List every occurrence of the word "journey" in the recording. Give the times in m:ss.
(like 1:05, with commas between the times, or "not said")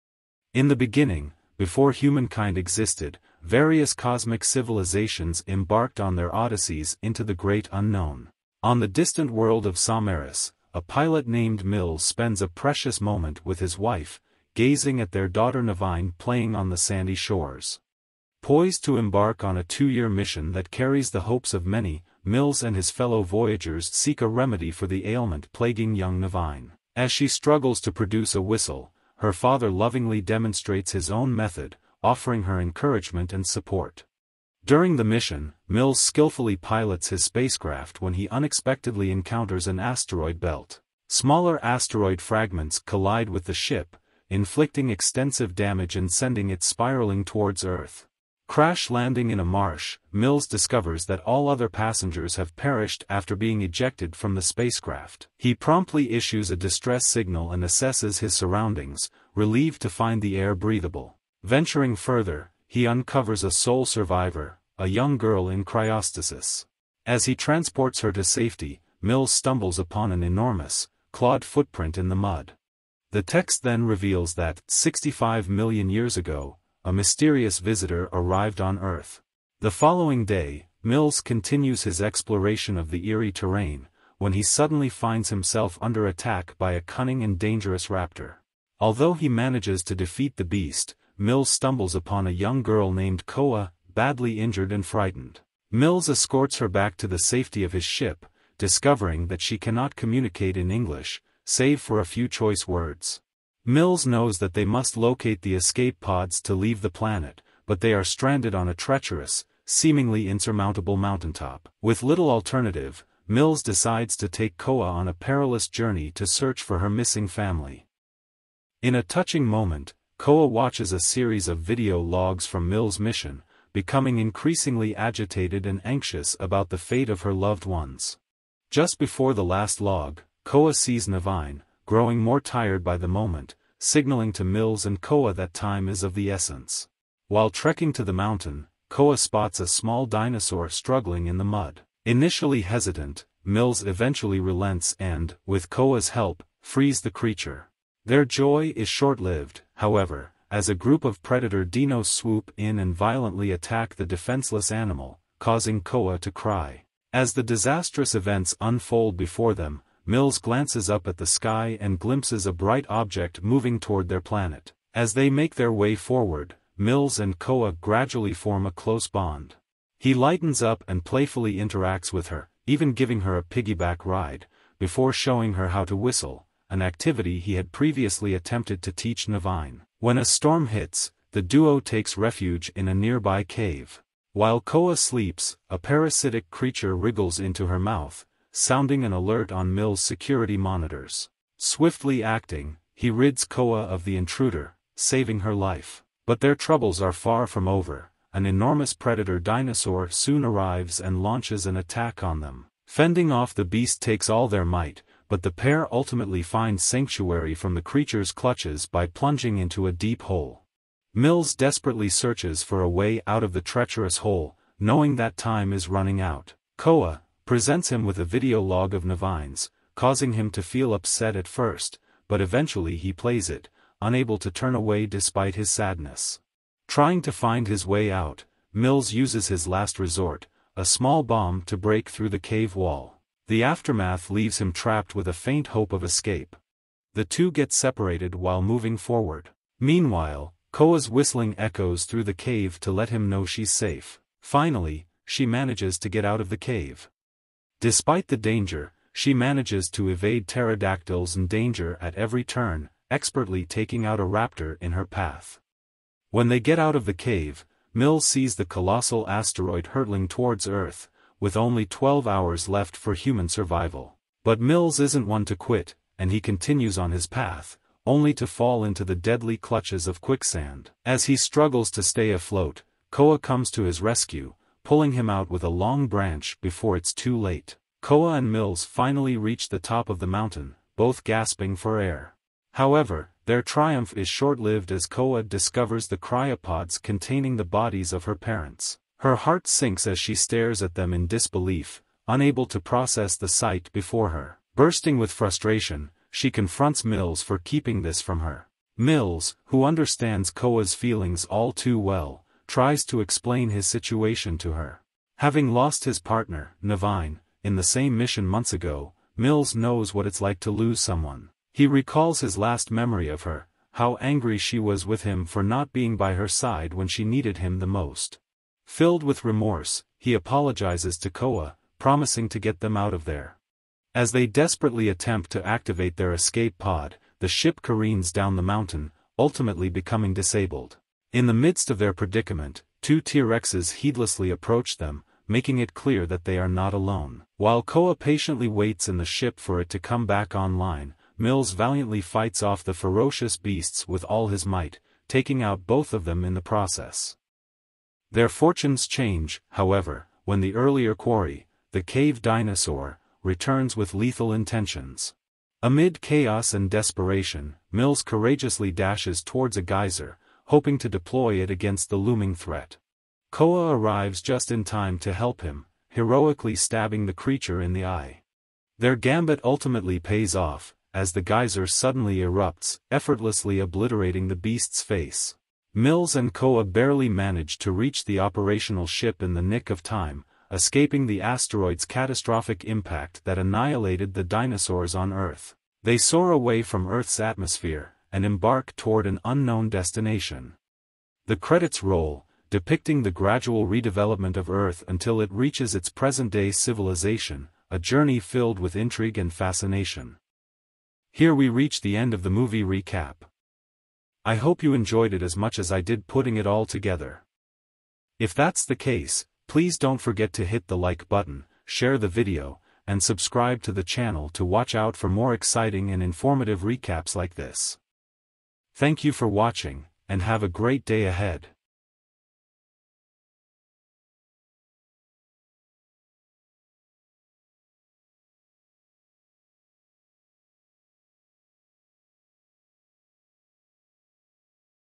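1:55, 6:37.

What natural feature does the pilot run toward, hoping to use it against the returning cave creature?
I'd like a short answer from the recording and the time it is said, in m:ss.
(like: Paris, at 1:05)
a geyser, at 5:59.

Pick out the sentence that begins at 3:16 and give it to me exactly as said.
But their troubles are far from over, an enormous predator dinosaur soon arrives and launches an attack on them.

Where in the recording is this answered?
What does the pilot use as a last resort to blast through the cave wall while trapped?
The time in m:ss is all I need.
3:50.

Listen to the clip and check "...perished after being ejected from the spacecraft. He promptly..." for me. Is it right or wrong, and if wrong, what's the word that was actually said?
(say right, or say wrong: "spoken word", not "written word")
right.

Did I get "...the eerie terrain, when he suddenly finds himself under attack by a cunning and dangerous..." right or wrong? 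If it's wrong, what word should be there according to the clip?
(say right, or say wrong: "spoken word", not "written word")
right.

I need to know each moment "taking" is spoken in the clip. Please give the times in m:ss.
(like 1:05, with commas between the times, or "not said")
4:13, 5:45.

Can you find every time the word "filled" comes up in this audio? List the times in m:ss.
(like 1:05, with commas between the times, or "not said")
5:18, 6:38.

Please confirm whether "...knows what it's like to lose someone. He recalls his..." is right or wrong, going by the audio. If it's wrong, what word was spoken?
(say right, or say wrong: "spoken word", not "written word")
right.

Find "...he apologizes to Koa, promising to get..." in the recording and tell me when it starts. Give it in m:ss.
5:20.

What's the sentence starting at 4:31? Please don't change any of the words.
As he struggles to stay afloat, Koa comes to his rescue, pulling him out with a long branch before it's too late.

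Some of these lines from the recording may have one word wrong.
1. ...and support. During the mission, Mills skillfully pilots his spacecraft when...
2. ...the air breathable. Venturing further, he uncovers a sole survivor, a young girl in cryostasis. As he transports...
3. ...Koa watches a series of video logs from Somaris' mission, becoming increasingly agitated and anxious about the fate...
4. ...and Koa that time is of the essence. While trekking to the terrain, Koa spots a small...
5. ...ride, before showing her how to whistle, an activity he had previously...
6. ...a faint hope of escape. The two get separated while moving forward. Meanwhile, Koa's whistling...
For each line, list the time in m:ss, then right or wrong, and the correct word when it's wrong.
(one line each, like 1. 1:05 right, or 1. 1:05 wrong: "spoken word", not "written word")
1. 0:33 right
2. 1:00 right
3. 2:00 wrong: "Mills", not "Somaris"
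4. 2:14 wrong: "mountain", not "terrain"
5. 2:54 right
6. 3:55 right.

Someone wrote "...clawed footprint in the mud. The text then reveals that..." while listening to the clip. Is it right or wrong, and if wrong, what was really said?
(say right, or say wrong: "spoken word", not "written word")
right.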